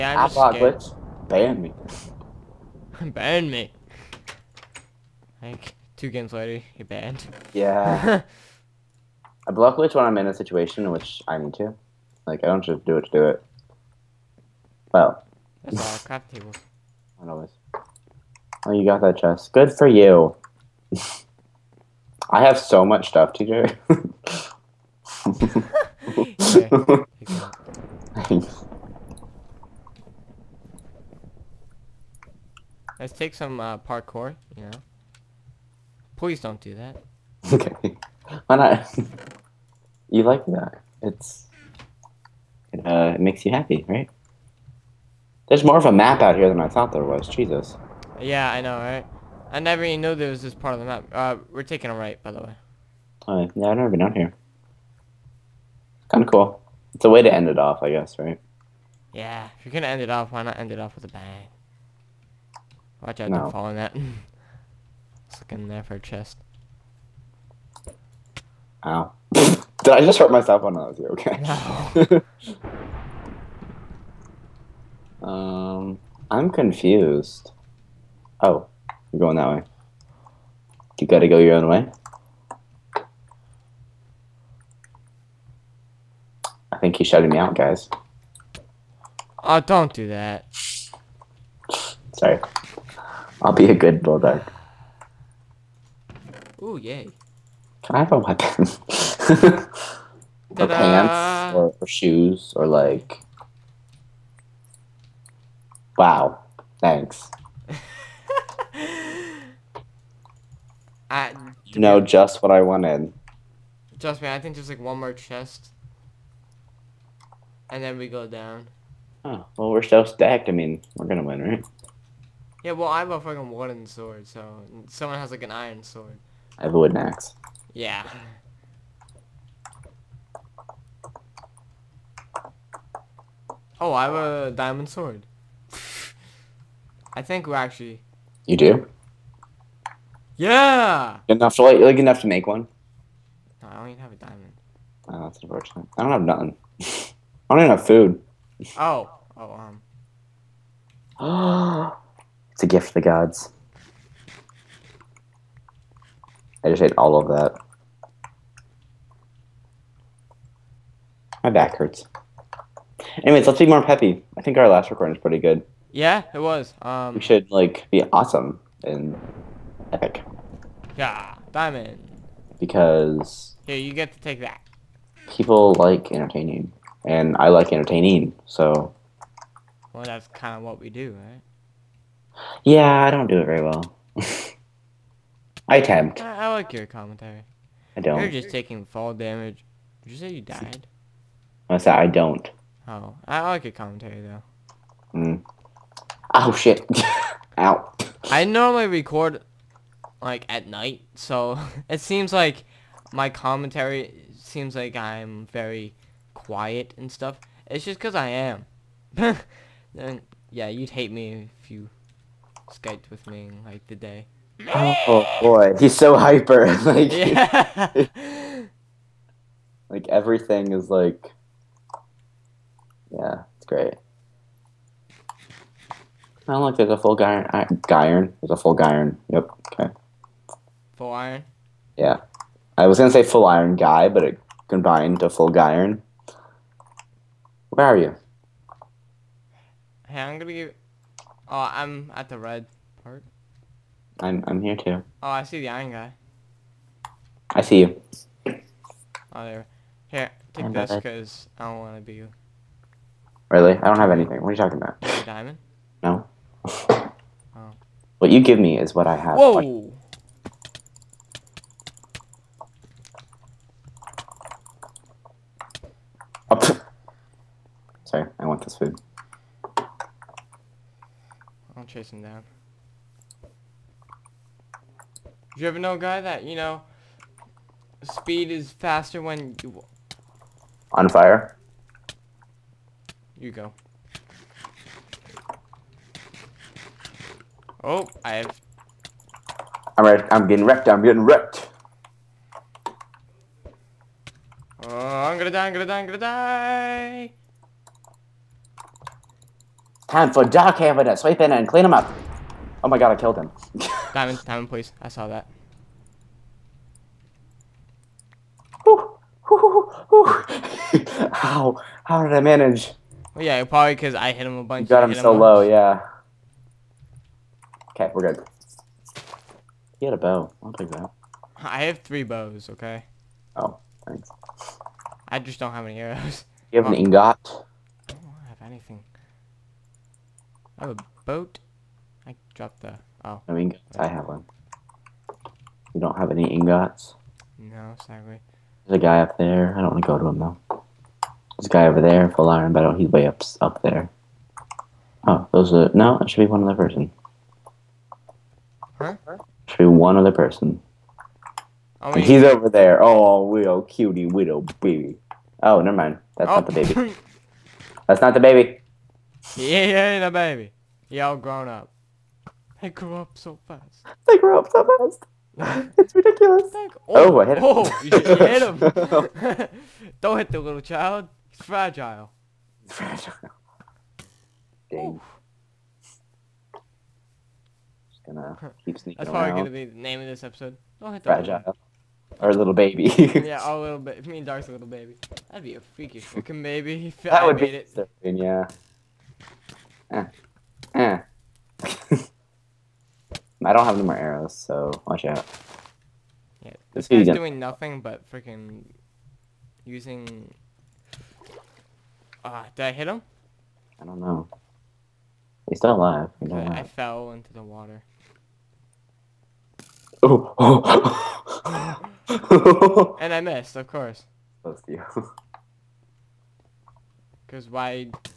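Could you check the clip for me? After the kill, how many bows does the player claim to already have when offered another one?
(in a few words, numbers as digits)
3.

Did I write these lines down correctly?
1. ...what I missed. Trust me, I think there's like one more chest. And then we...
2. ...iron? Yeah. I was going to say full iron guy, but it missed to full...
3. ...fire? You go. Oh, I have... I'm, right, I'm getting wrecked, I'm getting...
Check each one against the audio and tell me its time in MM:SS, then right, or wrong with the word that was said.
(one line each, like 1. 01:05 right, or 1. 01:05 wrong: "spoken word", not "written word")
1. 01:52 wrong: "wanted", not "missed"
2. 03:51 wrong: "combined", not "missed"
3. 04:41 right.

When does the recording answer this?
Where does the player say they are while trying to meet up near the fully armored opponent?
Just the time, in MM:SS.
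04:02.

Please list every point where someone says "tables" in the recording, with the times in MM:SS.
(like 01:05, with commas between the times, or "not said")
00:16.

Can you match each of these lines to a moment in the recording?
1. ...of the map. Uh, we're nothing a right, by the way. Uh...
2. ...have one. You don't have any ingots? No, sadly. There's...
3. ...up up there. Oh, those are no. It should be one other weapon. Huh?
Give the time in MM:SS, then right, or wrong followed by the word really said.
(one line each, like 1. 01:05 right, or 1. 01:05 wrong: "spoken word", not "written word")
1. 00:50 wrong: "taking", not "nothing"
2. 05:34 right
3. 05:43 wrong: "person", not "weapon".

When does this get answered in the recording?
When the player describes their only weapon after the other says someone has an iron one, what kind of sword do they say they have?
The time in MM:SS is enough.
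02:03.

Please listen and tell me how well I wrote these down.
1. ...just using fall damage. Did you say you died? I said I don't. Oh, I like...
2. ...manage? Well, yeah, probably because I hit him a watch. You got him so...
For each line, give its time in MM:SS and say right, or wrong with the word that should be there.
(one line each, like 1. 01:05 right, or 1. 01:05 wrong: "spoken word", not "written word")
1. 03:08 wrong: "taking", not "using"
2. 05:12 wrong: "bunch", not "watch".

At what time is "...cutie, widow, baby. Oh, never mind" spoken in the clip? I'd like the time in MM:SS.
05:53.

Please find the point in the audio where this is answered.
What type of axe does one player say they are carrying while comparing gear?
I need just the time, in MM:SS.
02:06.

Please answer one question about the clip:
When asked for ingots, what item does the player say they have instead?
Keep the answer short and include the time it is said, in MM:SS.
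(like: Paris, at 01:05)
a boat, at 05:30.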